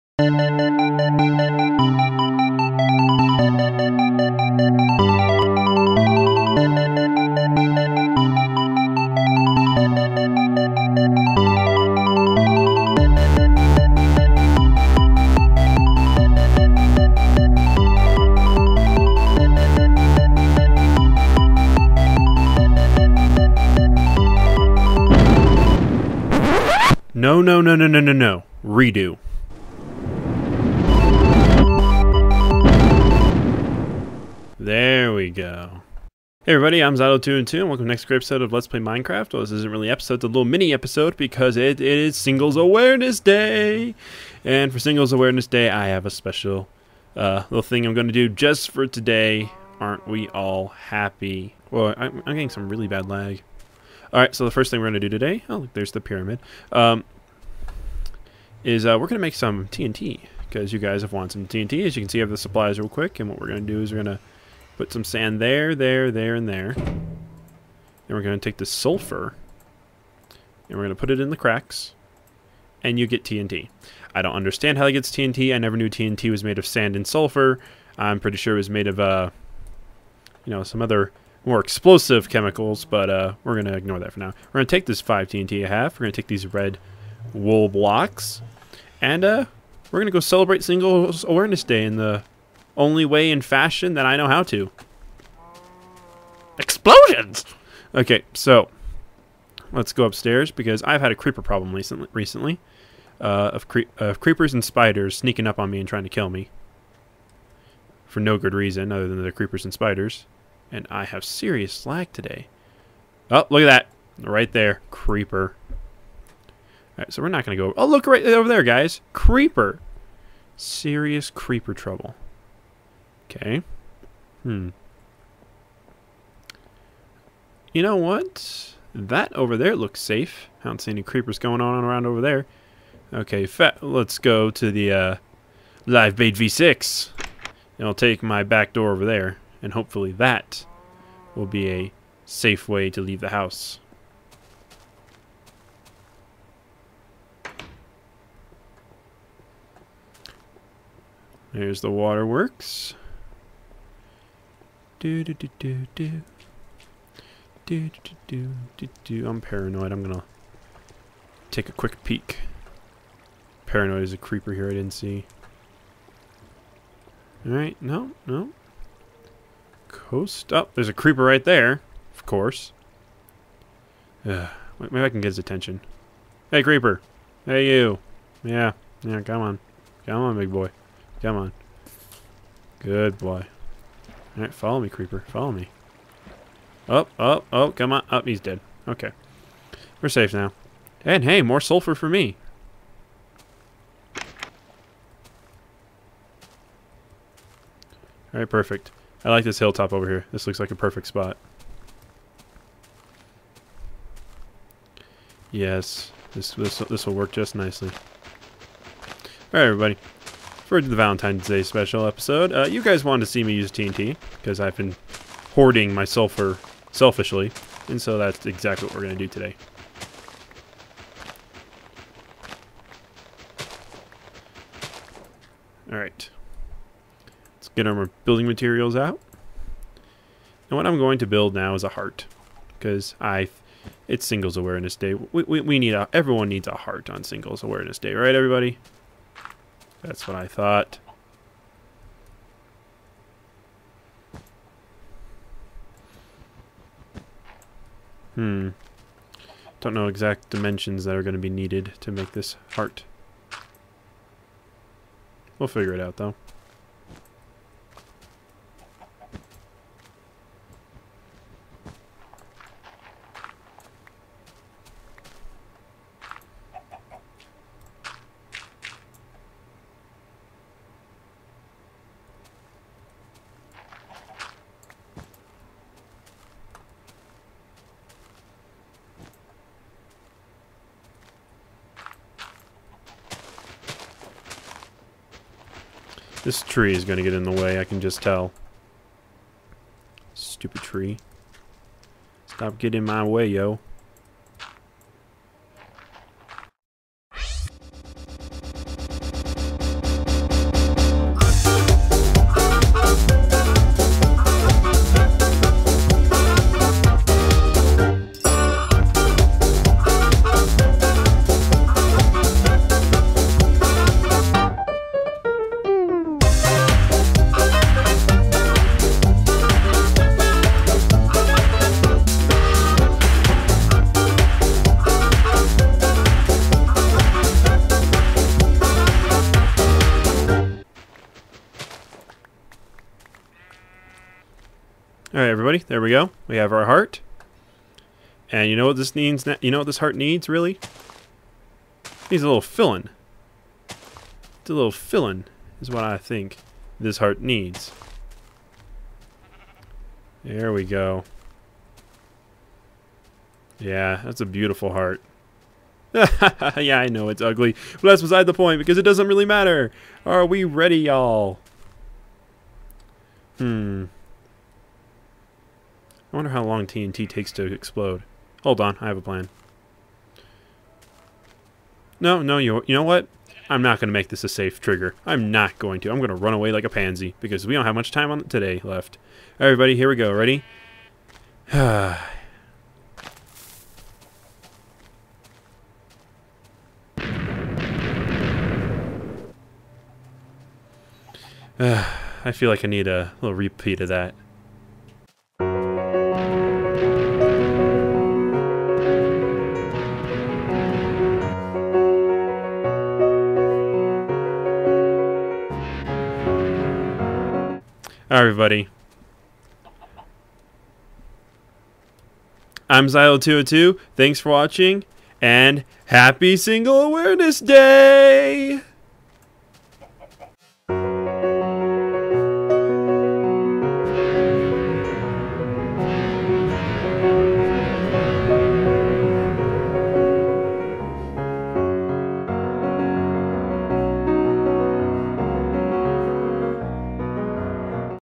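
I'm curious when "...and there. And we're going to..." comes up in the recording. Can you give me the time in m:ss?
1:06.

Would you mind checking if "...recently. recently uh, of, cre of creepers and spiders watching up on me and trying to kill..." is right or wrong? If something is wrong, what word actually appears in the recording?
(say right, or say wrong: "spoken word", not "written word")
wrong: "sneaking", not "watching".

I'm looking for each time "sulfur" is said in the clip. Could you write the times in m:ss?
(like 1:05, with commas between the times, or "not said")
1:08, 1:17, 3:11, 3:36.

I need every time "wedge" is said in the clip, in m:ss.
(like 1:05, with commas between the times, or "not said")
not said.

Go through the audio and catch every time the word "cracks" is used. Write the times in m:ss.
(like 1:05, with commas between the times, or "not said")
1:11.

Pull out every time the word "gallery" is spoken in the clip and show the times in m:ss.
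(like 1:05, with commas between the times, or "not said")
not said.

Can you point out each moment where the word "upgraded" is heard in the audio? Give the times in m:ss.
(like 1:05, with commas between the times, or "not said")
not said.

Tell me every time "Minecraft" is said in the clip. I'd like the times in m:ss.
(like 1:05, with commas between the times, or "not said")
0:38.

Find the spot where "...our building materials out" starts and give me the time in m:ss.
3:47.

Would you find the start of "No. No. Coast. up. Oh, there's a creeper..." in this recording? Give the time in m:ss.
2:47.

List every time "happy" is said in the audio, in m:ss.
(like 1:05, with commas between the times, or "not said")
0:50, 6:56.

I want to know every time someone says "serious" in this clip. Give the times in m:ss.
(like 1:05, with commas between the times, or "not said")
1:51, 2:00.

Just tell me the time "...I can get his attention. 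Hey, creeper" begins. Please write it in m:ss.
2:55.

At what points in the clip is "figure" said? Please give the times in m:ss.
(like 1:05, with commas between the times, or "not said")
4:15.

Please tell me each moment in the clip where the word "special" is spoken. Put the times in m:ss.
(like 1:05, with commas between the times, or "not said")
0:46, 3:31.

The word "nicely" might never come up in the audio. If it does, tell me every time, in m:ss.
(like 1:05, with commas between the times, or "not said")
3:27.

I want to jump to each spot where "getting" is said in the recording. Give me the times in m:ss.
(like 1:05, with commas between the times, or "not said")
0:52, 4:52.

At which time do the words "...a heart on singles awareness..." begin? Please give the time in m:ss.
3:56.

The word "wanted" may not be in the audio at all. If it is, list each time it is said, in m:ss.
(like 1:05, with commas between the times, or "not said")
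1:01, 3:33.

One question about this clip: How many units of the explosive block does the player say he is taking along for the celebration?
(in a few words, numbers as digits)
5.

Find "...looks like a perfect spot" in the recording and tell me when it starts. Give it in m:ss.
3:20.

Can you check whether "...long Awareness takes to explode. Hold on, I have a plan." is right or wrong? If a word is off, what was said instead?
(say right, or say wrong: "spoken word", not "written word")
wrong: "TNT", not "Awareness".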